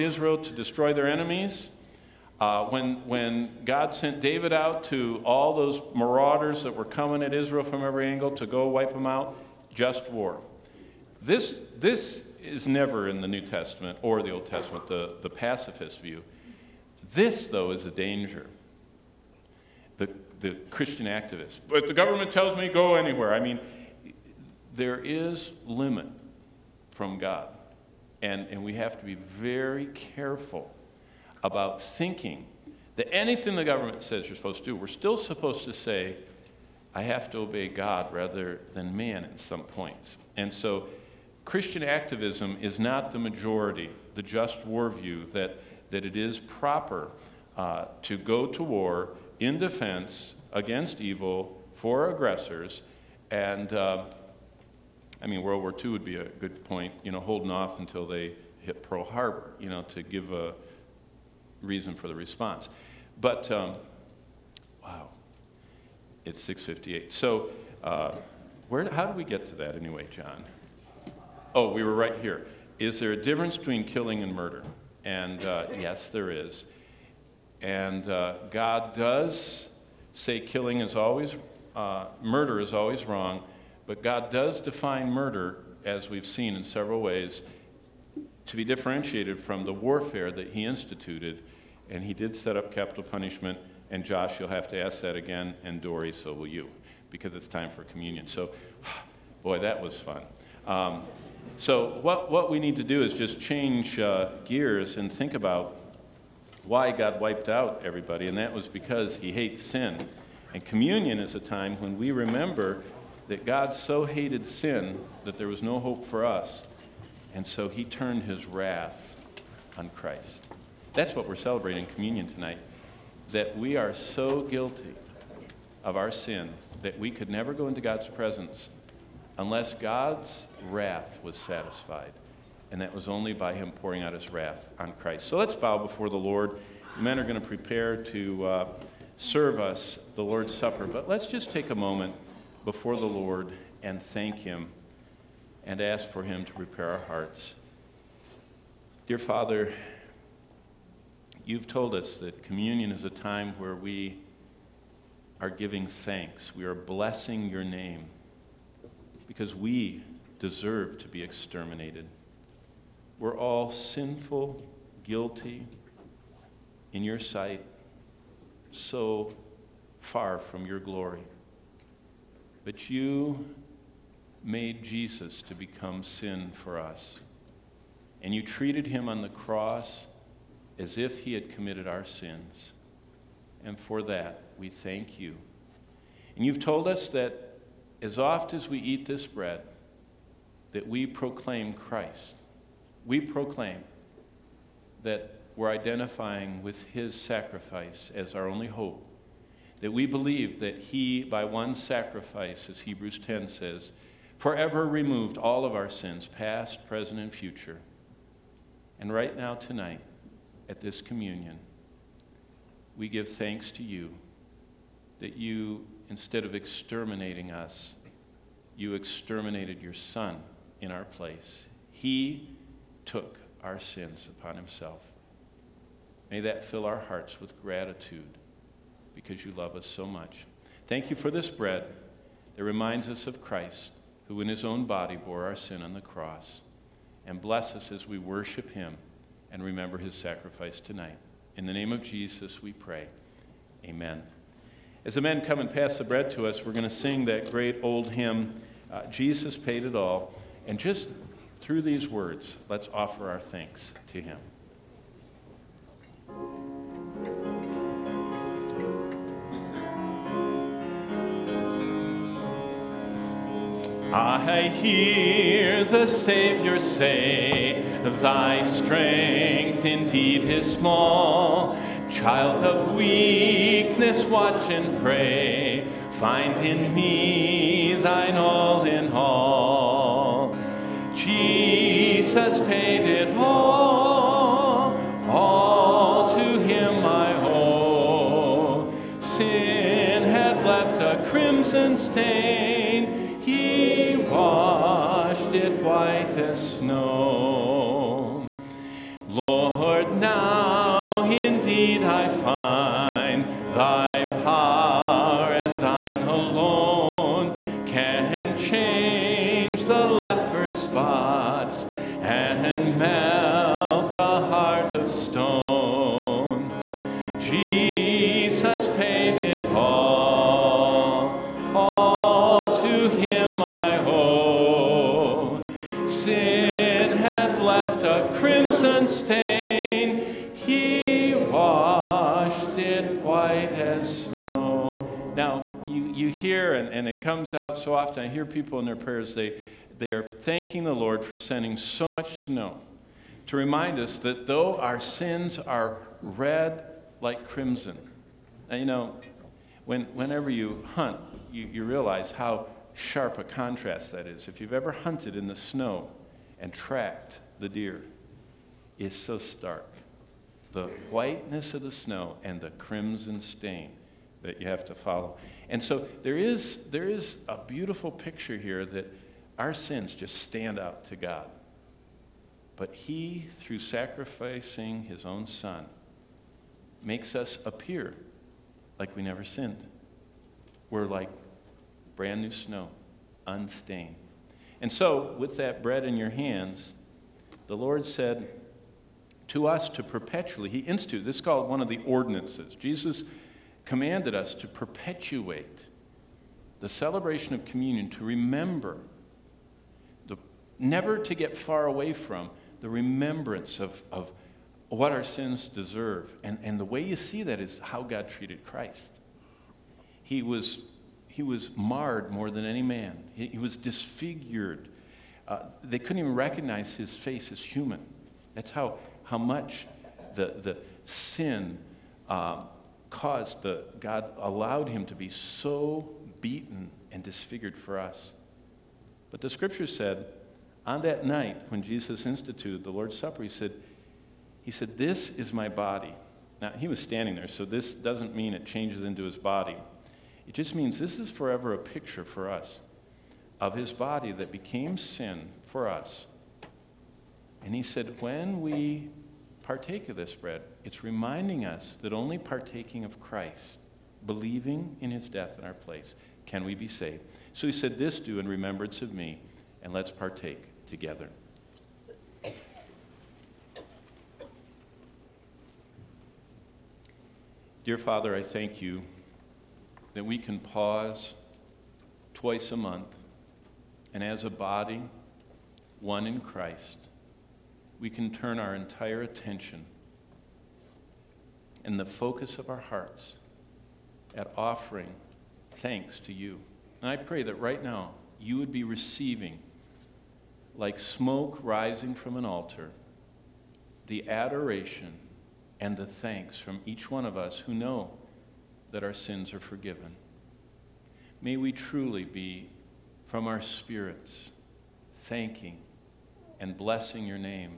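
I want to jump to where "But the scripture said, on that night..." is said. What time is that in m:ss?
7:09.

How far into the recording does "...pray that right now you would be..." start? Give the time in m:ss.
8:07.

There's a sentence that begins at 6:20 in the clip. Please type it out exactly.
We're like brand new snow, unstained.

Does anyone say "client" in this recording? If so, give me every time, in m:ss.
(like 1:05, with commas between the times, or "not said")
not said.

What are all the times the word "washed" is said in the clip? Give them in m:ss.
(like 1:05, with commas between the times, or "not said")
4:54, 5:31.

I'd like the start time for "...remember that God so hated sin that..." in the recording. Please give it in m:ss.
1:52.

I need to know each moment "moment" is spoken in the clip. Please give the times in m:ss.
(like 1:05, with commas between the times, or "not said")
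2:21.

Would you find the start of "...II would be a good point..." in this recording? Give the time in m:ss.
0:55.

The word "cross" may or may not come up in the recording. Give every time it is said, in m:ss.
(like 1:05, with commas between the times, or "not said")
2:59, 3:55.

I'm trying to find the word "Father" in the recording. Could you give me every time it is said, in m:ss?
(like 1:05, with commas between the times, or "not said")
2:29, 7:47.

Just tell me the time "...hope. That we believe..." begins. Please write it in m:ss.
3:18.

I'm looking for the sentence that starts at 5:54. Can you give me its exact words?
If you've ever hunted in the snow and tracked the deer, is so stark.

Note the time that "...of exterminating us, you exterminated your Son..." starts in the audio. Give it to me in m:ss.
3:36.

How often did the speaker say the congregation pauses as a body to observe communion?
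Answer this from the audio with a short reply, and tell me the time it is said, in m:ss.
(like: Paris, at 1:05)
Twice a month, at 7:52.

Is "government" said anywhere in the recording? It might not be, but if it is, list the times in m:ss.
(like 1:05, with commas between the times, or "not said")
0:21, 0:33.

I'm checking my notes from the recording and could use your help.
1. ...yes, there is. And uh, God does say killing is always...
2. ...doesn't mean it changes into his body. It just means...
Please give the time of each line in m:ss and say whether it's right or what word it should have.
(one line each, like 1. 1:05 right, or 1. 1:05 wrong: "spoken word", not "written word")
1. 1:15 right
2. 7:17 right.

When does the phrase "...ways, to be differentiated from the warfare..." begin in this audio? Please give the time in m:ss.
1:27.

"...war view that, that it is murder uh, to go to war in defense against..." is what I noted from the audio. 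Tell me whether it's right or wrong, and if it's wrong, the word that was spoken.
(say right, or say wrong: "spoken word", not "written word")
wrong: "proper", not "murder".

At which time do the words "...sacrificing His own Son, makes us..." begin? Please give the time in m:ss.
6:13.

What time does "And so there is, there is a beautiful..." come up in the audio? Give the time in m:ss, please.
6:05.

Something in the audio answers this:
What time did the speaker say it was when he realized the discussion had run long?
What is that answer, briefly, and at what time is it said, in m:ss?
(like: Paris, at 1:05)
6:58, at 1:06.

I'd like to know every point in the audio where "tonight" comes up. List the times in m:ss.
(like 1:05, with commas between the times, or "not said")
2:02, 3:29, 4:00.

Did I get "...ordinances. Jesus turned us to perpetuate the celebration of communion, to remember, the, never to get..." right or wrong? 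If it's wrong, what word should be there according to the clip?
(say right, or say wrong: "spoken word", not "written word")
wrong: "commanded", not "turned".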